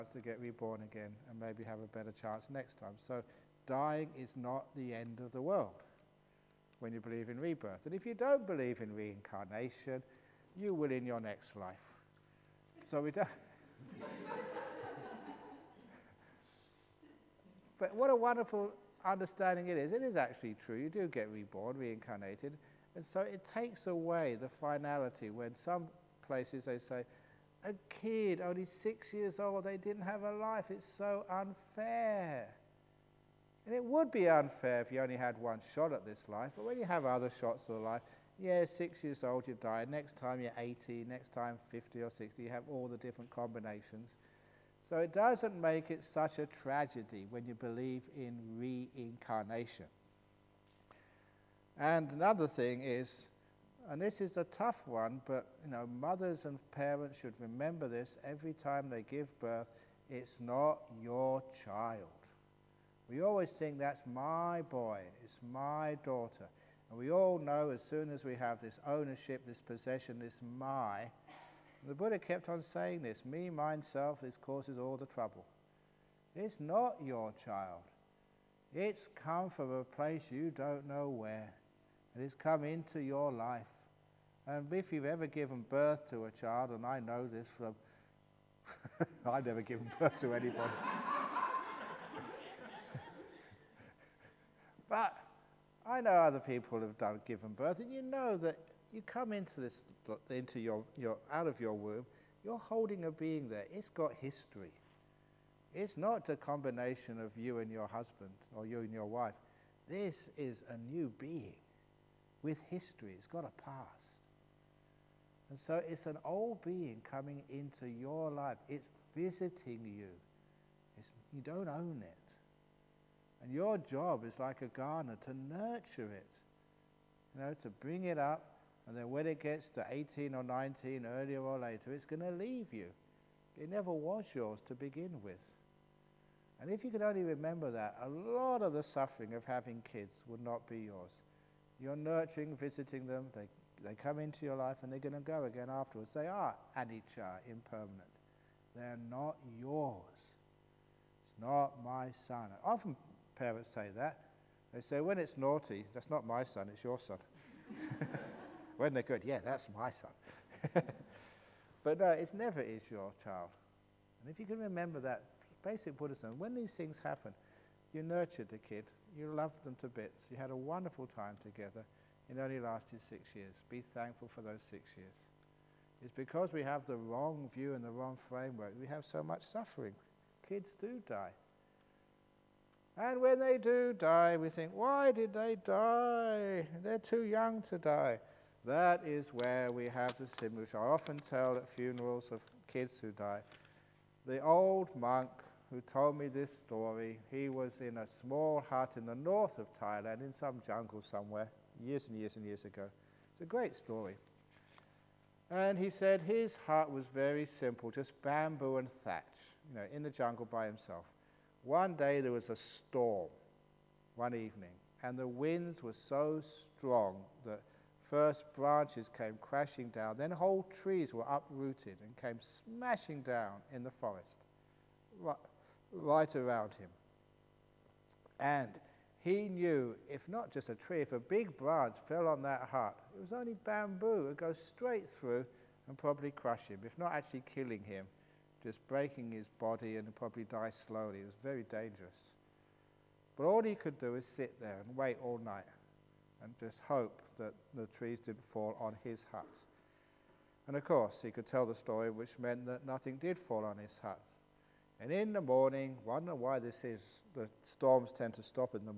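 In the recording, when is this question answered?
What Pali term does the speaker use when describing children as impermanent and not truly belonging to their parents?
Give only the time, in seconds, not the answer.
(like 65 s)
146 s.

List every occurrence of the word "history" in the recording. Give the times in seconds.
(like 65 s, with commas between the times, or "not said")
104 s, 112 s.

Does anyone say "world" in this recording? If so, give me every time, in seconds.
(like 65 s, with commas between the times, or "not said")
5 s.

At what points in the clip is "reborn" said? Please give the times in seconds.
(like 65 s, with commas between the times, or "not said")
0 s, 21 s.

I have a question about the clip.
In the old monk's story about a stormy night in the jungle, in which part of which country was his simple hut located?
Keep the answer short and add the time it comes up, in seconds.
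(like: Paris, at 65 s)
North of Thailand, at 199 s.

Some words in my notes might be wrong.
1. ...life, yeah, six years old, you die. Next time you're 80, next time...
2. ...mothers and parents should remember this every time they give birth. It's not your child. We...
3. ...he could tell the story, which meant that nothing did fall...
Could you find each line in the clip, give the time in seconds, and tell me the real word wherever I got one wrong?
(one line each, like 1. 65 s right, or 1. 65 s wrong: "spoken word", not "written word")
1. 37 s right
2. 55 s right
3. 251 s right.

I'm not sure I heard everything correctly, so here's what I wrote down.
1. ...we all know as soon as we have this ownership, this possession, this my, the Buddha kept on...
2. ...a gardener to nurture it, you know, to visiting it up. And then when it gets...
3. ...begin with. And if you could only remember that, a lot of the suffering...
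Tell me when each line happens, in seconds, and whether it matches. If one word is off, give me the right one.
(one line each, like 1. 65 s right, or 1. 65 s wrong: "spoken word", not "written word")
1. 66 s right
2. 124 s wrong: "bring", not "visiting"
3. 134 s right.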